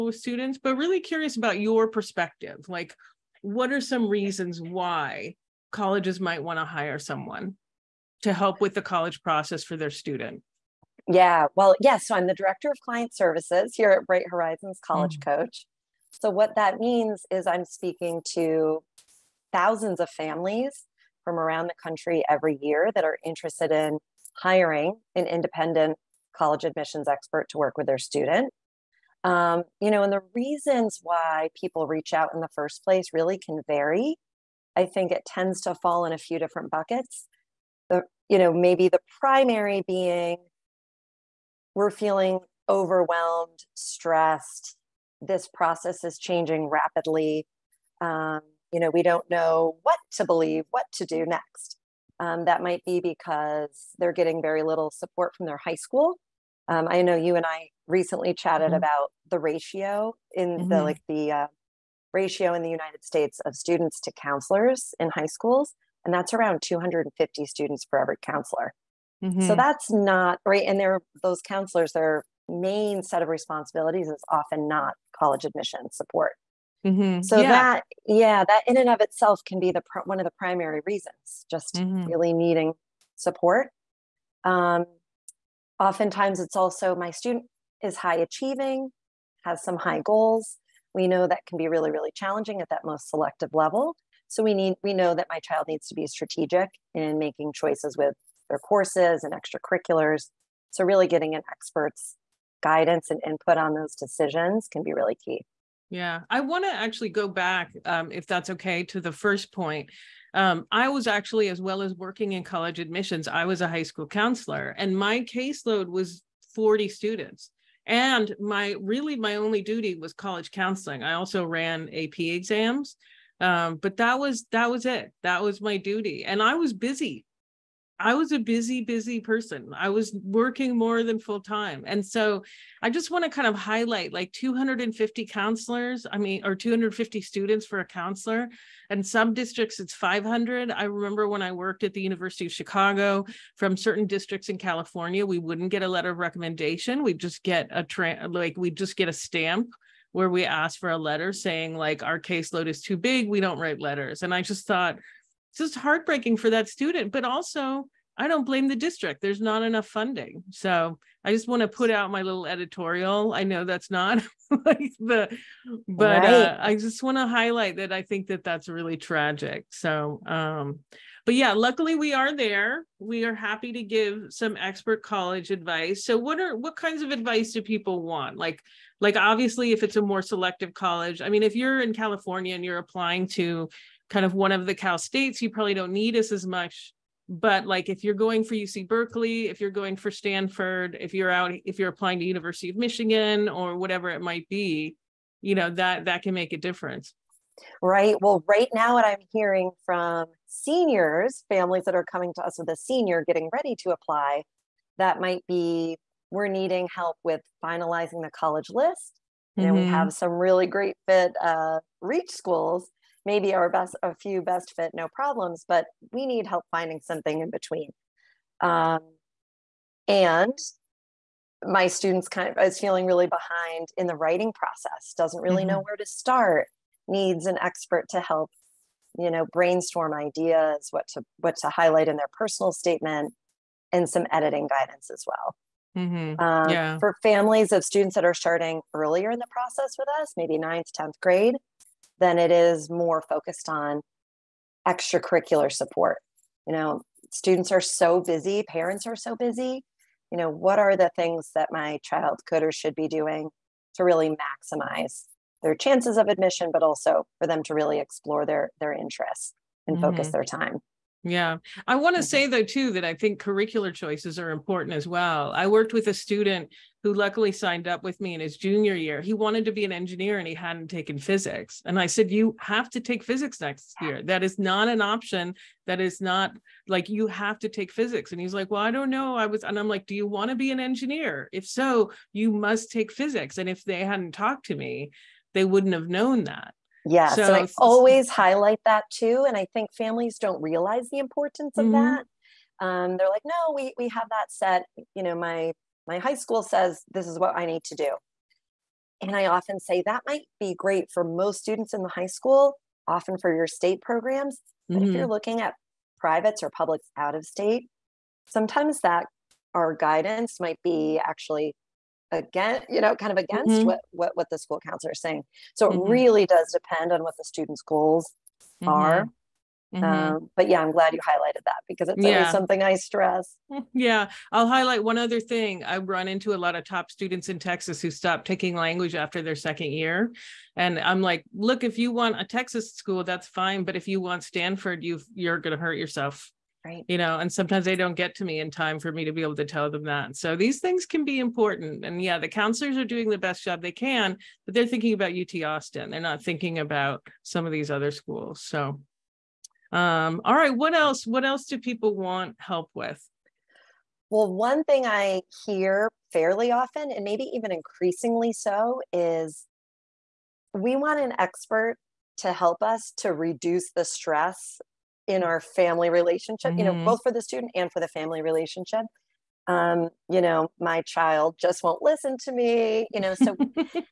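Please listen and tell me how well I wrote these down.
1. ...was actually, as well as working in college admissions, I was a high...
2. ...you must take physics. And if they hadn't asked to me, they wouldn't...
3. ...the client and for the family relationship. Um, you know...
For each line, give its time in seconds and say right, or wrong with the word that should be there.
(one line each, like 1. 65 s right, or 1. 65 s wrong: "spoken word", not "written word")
1. 110 s right
2. 282 s wrong: "talked", not "asked"
3. 367 s wrong: "student", not "client".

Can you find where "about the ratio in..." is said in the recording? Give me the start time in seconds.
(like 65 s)
58 s.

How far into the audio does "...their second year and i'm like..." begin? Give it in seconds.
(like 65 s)
329 s.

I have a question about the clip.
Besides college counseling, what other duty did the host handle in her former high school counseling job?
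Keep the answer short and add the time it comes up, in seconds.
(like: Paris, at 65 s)
AP exams, at 121 s.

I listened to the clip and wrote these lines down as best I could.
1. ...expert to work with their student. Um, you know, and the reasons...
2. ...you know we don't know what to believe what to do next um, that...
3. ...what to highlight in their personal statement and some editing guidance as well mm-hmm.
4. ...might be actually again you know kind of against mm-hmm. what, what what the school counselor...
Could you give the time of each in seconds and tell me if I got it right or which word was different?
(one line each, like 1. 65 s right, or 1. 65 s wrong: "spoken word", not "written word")
1. 27 s right
2. 48 s right
3. 231 s right
4. 310 s right.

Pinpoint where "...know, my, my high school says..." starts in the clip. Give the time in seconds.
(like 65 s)
295 s.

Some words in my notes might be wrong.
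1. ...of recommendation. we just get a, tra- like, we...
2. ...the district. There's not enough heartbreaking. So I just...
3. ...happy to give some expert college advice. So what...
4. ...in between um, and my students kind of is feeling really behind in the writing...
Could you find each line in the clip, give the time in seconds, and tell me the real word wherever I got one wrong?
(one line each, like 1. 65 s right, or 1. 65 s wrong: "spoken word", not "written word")
1. 146 s right
2. 158 s wrong: "funding", not "heartbreaking"
3. 173 s right
4. 217 s right.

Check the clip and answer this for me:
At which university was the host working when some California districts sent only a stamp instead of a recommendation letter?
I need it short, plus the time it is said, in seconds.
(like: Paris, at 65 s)
University of Chicago, at 142 s.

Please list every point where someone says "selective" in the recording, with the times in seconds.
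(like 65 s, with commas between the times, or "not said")
93 s, 180 s.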